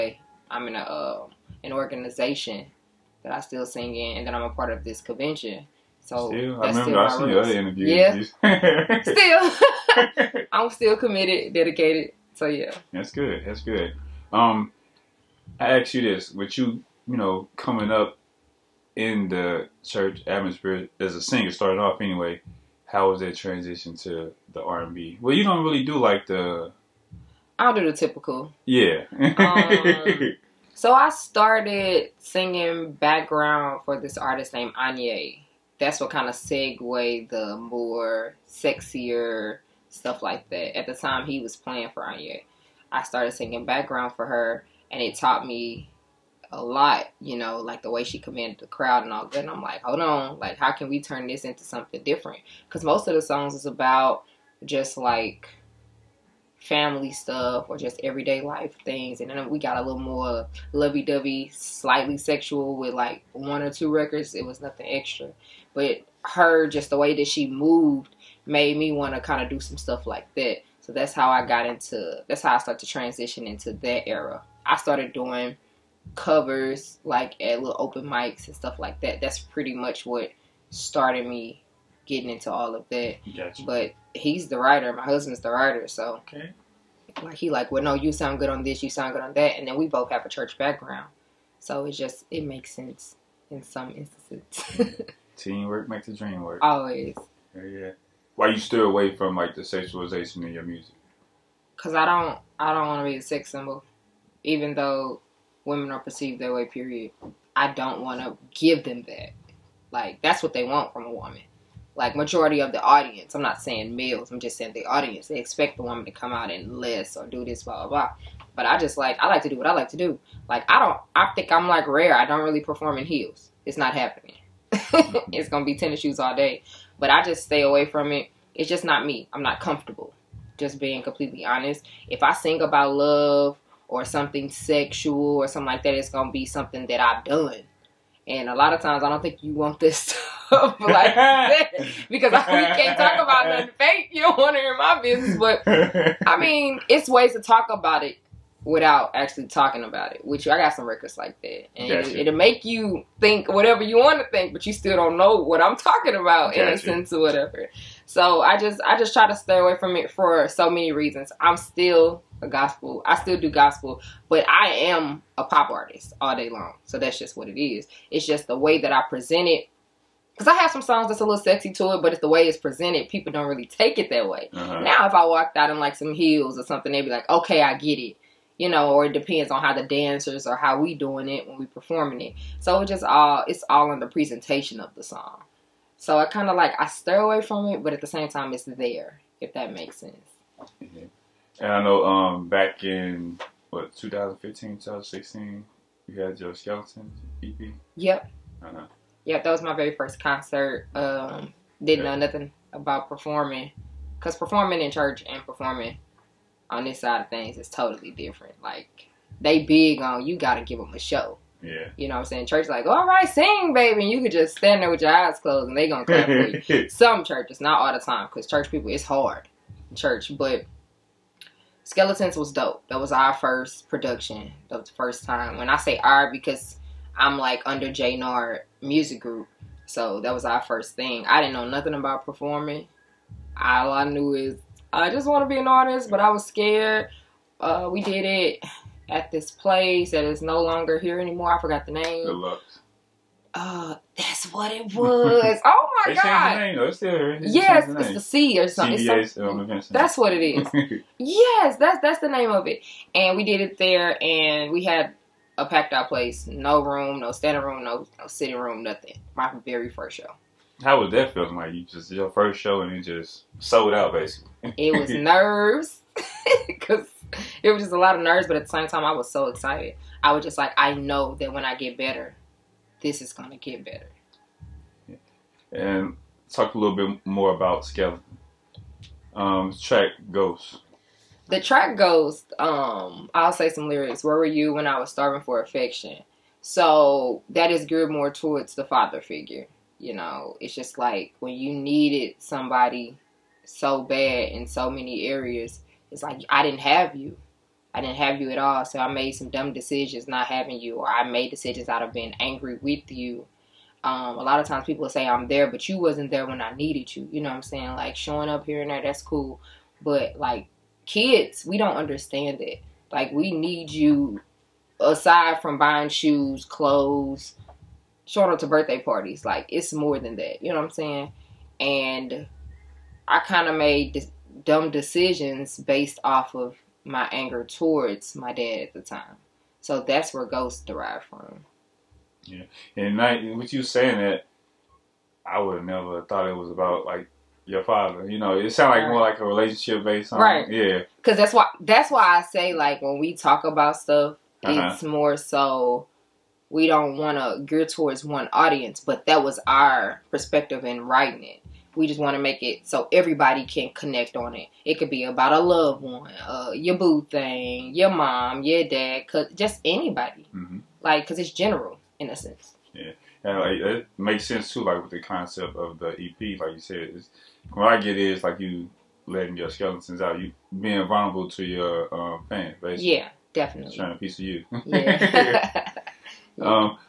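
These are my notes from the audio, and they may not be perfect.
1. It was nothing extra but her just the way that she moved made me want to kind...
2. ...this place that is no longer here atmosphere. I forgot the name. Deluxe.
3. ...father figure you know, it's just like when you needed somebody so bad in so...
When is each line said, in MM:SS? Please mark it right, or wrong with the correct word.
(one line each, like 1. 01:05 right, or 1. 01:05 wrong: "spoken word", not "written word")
1. 01:04 right
2. 03:59 wrong: "anymore", not "atmosphere"
3. 04:48 right.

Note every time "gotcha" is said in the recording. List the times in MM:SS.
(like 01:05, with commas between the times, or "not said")
01:23, 02:31, 02:36.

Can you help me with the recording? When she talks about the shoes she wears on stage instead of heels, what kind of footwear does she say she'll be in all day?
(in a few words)
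Tennis shoes.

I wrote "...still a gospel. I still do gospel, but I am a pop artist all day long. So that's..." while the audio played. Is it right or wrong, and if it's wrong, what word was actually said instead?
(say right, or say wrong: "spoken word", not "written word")
right.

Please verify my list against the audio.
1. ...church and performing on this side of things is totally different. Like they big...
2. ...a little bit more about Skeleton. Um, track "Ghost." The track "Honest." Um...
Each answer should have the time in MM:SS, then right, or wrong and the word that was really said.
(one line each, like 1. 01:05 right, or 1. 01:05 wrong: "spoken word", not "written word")
1. 03:24 right
2. 04:36 wrong: "Ghost", not "Honest".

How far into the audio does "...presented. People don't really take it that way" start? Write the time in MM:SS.
02:52.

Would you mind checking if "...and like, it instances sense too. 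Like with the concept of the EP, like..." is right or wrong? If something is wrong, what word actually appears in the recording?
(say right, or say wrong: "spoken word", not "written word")
wrong: "makes", not "instances".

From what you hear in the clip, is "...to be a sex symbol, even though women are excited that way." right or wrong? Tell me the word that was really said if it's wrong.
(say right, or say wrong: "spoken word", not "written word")
wrong: "perceived", not "excited".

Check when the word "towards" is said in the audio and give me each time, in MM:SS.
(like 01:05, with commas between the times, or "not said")
04:48, 05:27, 05:47.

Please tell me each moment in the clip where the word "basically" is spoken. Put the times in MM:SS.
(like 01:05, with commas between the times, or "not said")
04:24, 06:12.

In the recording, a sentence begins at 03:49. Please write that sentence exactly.
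So that was our first thing.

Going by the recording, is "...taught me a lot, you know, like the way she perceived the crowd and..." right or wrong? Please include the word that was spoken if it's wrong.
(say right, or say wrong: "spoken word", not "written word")
wrong: "commanded", not "perceived".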